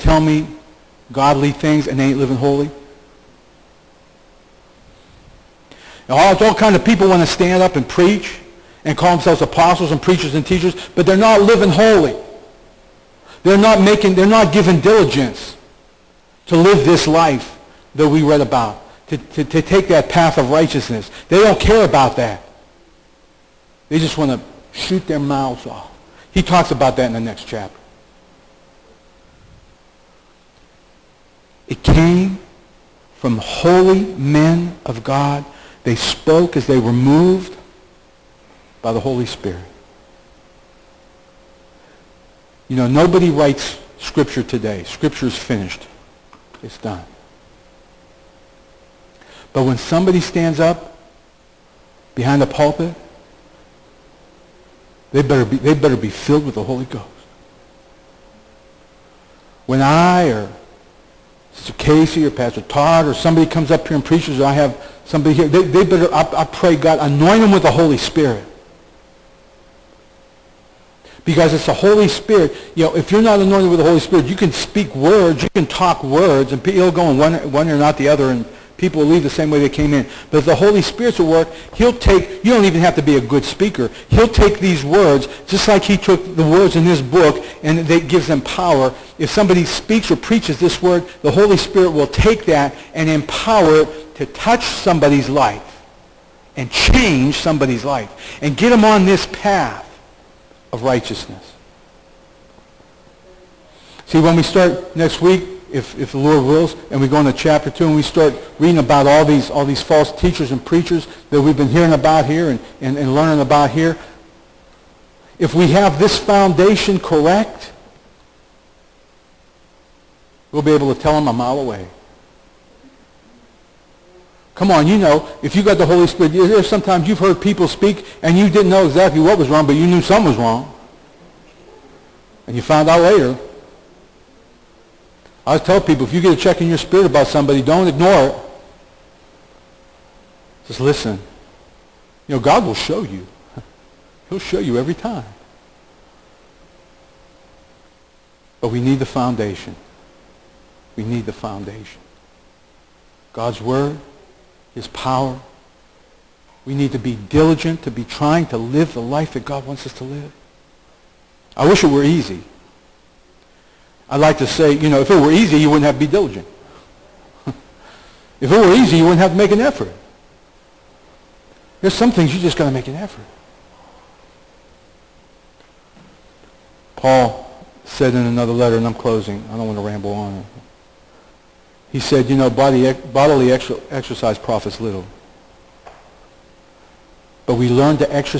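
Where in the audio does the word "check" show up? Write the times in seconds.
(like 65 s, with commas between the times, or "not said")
136 s.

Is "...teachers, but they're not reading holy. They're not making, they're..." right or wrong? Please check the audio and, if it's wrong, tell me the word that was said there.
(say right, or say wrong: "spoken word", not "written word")
wrong: "living", not "reading".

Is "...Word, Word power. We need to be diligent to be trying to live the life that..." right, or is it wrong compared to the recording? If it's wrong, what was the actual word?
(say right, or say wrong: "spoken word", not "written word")
wrong: "His", not "Word".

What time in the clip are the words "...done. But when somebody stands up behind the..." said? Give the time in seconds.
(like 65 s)
46 s.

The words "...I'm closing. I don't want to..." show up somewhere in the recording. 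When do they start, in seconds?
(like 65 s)
178 s.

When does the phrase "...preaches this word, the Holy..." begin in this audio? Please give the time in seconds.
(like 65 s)
90 s.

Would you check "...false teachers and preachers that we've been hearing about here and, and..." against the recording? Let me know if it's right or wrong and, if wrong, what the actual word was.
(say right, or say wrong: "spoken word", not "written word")
right.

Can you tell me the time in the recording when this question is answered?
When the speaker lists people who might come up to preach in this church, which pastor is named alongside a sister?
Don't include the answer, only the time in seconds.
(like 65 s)
62 s.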